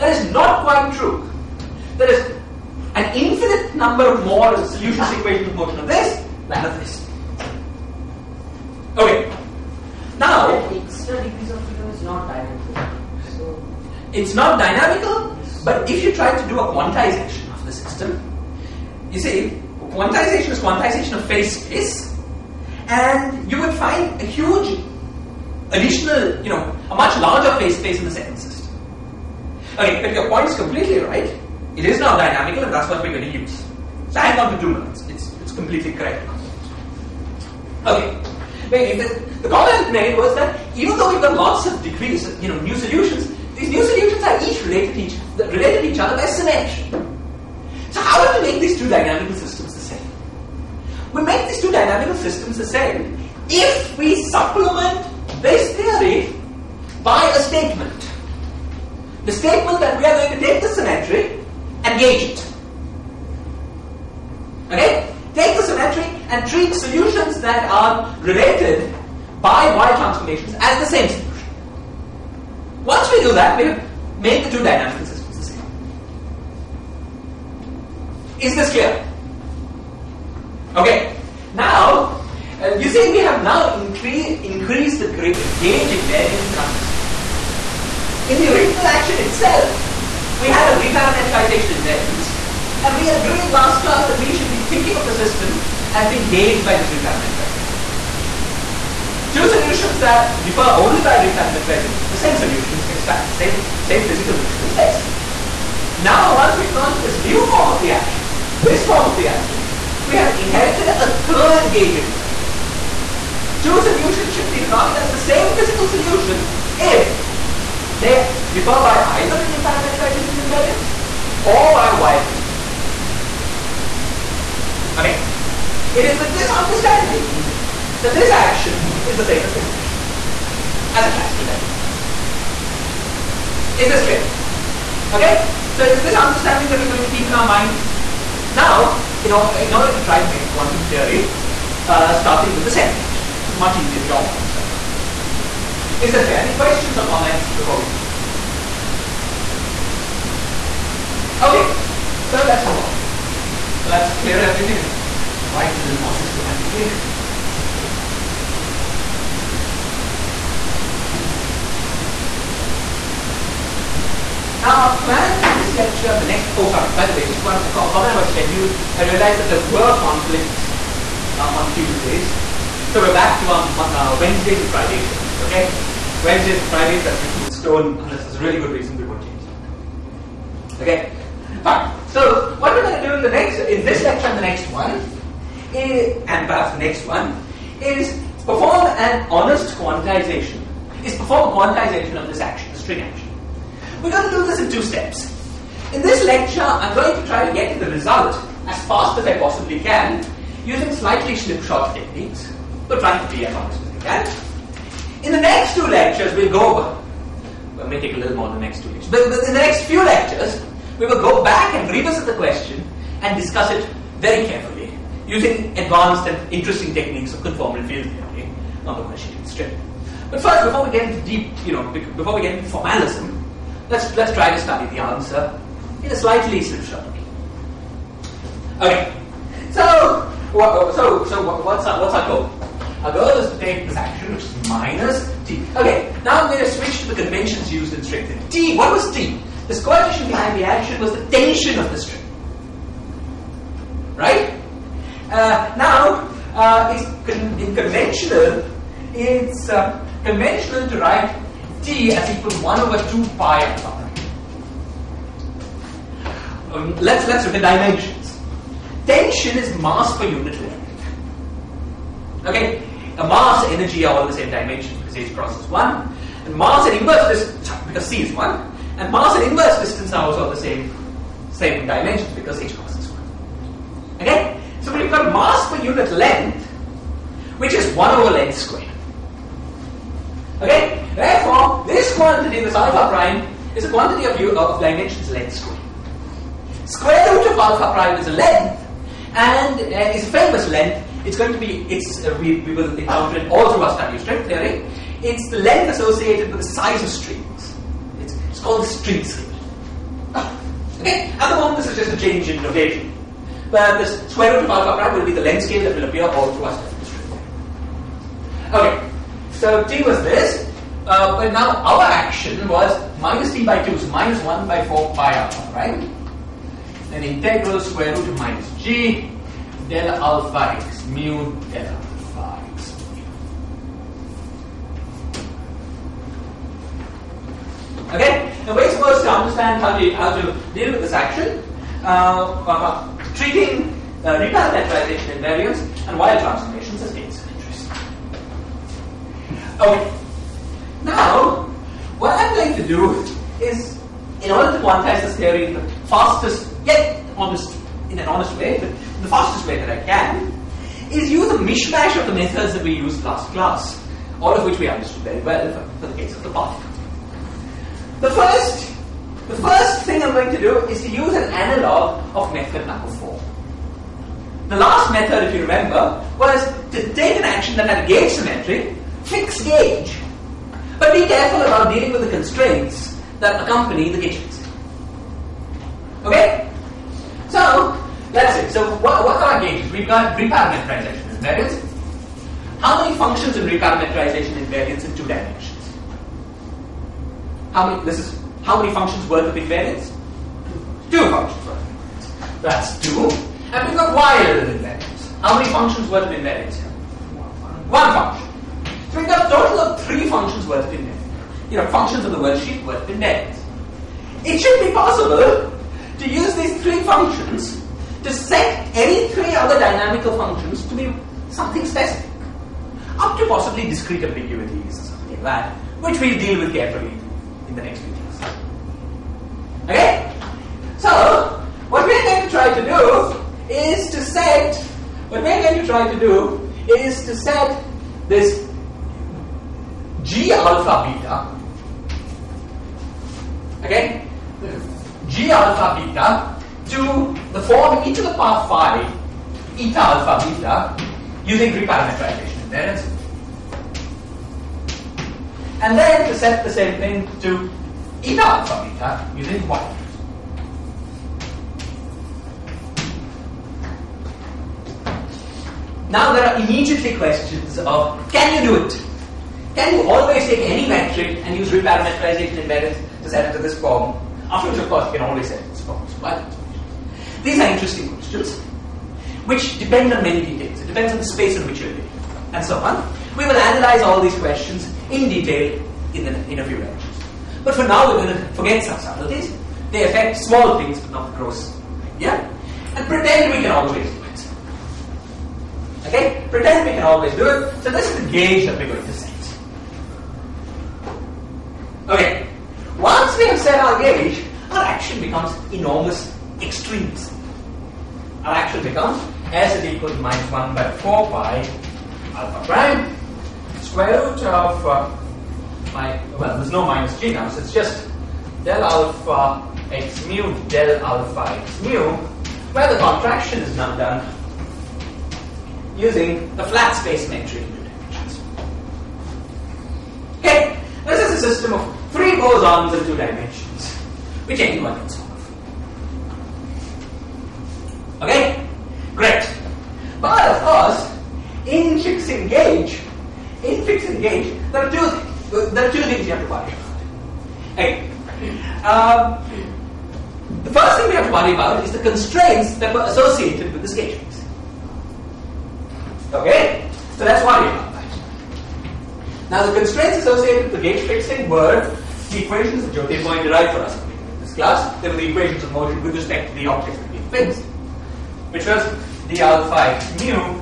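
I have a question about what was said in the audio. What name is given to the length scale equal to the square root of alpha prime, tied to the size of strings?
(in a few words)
the string scale.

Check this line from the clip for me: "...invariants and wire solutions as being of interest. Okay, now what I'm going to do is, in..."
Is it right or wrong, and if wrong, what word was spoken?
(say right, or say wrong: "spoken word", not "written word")
wrong: "transformations", not "solutions".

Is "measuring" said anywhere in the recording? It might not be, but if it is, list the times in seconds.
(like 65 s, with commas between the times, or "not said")
not said.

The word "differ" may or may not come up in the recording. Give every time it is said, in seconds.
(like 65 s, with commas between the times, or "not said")
100 s, 118 s.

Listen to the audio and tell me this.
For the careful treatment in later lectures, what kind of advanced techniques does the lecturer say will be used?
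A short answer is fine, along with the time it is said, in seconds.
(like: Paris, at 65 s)
conformal field theory, at 217 s.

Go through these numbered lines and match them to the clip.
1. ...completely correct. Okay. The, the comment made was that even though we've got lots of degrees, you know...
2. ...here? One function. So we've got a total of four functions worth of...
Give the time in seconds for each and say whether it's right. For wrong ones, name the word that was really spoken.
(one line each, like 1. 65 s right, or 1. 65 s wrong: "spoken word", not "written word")
1. 35 s right
2. 396 s wrong: "three", not "four".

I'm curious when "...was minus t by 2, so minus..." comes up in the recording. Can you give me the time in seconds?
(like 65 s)
312 s.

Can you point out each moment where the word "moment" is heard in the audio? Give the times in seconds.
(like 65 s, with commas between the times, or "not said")
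301 s.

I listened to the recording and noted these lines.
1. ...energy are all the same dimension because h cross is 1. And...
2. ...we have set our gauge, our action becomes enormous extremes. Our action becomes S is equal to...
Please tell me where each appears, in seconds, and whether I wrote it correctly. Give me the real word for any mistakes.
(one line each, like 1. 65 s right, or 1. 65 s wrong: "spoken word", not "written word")
1. 263 s right
2. 493 s right.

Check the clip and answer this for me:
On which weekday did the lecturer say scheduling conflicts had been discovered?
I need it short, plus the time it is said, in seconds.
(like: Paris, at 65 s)
Tuesdays, at 171 s.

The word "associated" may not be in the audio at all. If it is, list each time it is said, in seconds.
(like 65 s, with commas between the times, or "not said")
295 s, 543 s, 550 s.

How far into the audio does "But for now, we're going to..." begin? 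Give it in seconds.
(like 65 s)
477 s.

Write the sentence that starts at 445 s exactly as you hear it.
And then to set the same thing to eta alpha beta using Weyl.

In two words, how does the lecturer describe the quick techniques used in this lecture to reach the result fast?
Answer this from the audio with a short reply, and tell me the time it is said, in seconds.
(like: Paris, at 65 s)
slightly slipshod, at 200 s.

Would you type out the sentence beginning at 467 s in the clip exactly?
These are interesting questions, which depend on many details.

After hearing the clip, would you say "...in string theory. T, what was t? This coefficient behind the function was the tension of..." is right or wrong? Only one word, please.
wrong.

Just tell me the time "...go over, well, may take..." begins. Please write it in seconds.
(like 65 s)
206 s.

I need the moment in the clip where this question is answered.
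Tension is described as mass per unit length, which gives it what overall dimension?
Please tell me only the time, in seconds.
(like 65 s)
277 s.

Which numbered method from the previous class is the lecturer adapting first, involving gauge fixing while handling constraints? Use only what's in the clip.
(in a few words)
method number four.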